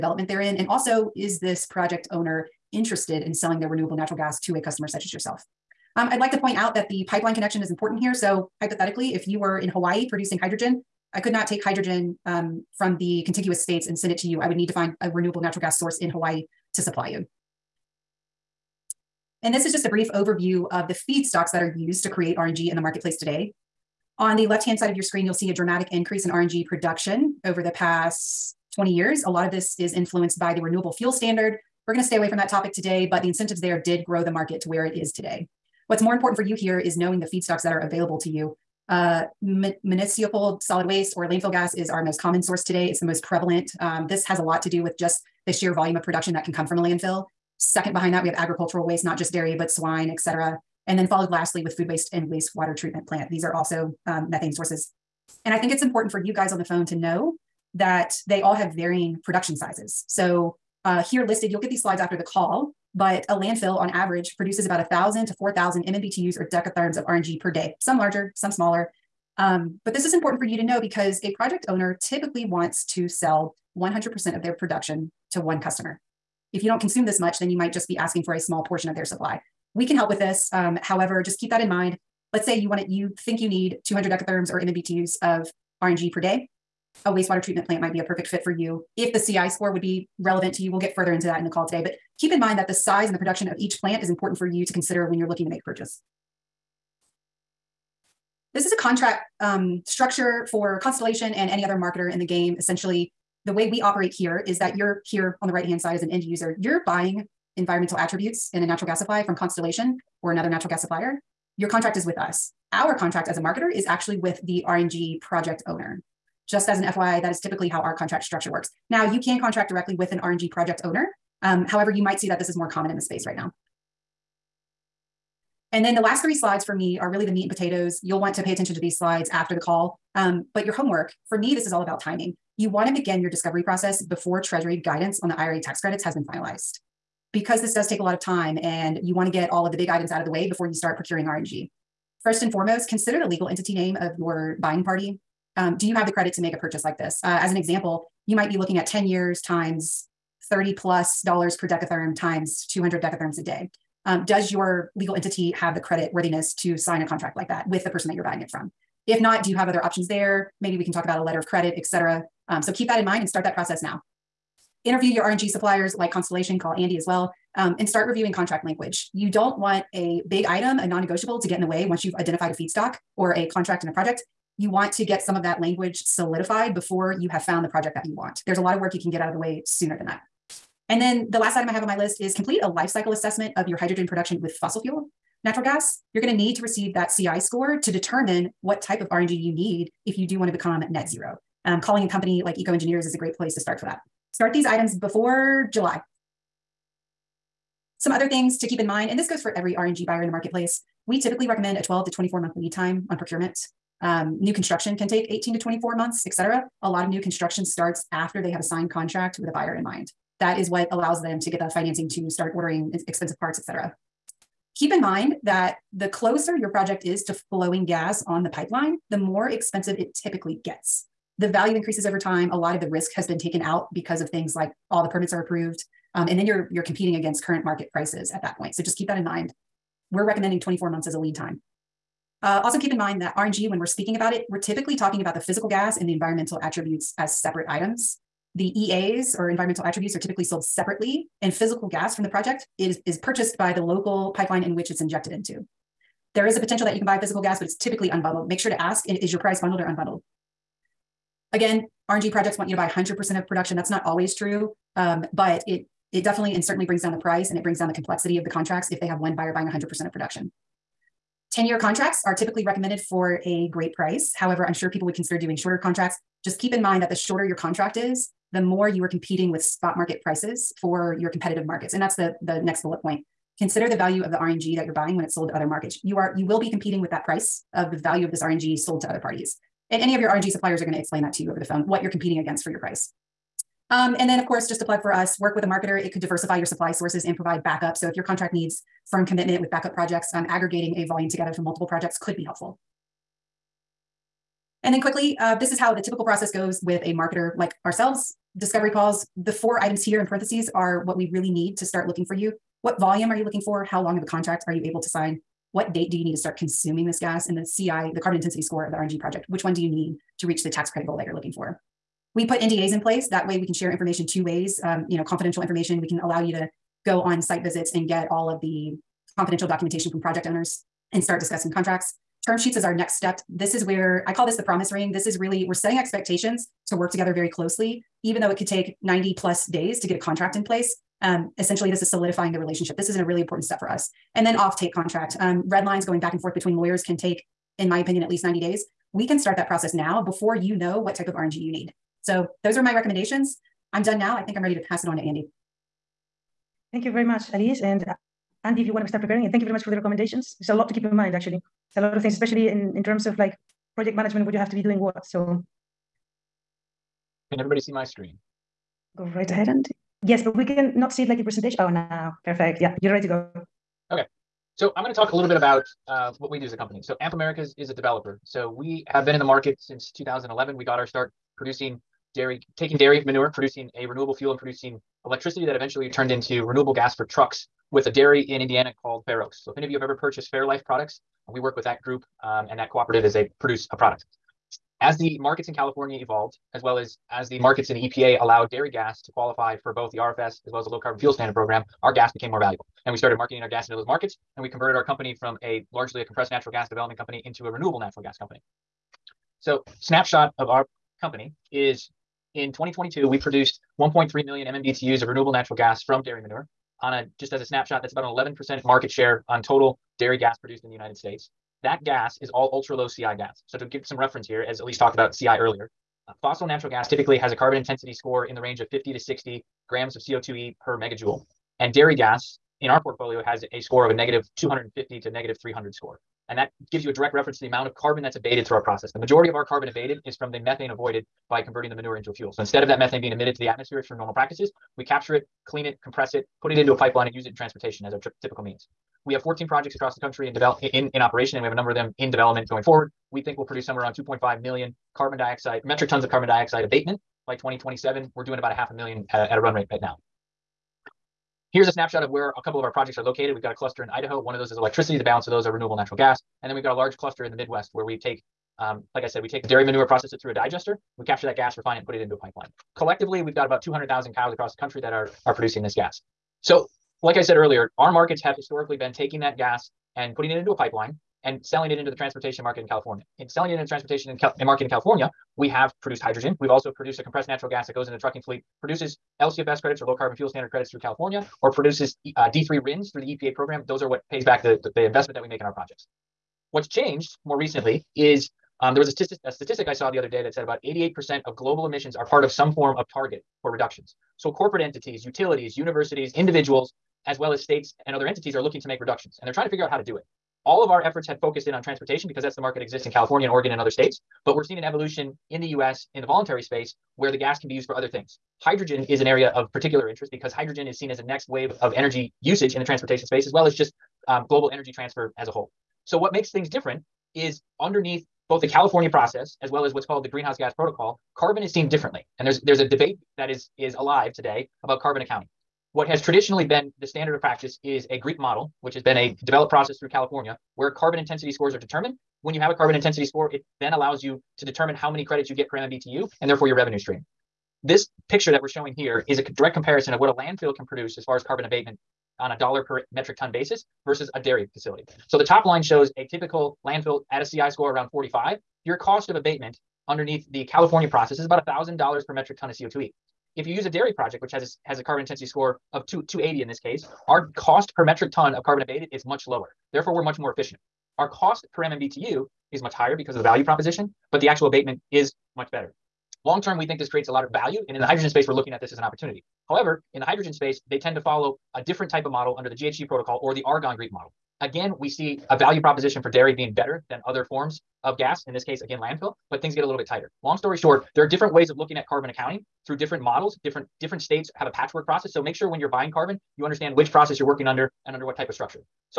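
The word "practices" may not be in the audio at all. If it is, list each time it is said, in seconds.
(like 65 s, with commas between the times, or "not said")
434 s, 527 s.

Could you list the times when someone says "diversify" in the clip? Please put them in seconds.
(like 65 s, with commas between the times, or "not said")
286 s.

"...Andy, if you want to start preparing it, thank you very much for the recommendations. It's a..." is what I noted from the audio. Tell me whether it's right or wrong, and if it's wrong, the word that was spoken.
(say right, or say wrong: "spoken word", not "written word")
right.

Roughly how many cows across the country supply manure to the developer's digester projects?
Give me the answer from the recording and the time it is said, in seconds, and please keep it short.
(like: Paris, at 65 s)
200,000, at 463 s.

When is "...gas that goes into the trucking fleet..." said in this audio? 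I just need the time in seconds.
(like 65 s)
477 s.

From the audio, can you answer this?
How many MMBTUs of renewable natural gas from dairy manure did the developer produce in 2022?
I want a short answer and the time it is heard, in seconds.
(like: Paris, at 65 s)
1.3 million, at 403 s.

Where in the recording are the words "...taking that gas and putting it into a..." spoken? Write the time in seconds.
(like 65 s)
469 s.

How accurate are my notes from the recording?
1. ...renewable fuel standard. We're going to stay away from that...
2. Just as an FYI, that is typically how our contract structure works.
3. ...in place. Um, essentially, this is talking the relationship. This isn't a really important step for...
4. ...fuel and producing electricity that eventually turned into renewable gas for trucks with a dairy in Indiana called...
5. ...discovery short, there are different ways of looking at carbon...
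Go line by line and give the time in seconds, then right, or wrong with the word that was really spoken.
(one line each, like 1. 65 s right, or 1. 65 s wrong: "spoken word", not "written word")
1. 30 s right
2. 116 s right
3. 330 s wrong: "solidifying", not "talking"
4. 374 s right
5. 580 s wrong: "story", not "discovery".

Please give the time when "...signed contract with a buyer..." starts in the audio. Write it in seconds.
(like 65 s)
208 s.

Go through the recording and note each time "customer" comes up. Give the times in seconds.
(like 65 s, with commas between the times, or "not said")
4 s, 75 s.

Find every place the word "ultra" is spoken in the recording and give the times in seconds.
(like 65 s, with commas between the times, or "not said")
412 s.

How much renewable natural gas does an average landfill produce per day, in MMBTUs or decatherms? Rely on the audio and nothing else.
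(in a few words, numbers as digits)
1,000 to 4,000.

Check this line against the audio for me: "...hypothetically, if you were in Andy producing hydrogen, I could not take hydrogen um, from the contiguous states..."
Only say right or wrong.
wrong.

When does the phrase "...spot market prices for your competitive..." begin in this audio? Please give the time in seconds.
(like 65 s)
269 s.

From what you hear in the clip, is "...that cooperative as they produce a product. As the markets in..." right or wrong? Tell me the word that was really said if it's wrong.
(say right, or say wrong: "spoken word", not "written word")
right.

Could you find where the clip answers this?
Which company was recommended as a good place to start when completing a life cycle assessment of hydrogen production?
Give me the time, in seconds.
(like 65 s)
192 s.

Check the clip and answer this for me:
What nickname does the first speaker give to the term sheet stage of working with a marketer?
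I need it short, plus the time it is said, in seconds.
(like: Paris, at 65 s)
the promise ring, at 324 s.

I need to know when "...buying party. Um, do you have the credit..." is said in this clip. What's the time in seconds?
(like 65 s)
144 s.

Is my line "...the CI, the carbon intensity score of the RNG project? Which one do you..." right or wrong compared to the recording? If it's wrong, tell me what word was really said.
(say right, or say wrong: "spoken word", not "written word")
right.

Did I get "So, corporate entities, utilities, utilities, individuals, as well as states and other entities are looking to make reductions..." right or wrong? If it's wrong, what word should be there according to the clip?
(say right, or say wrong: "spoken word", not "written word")
wrong: "universities", not "utilities".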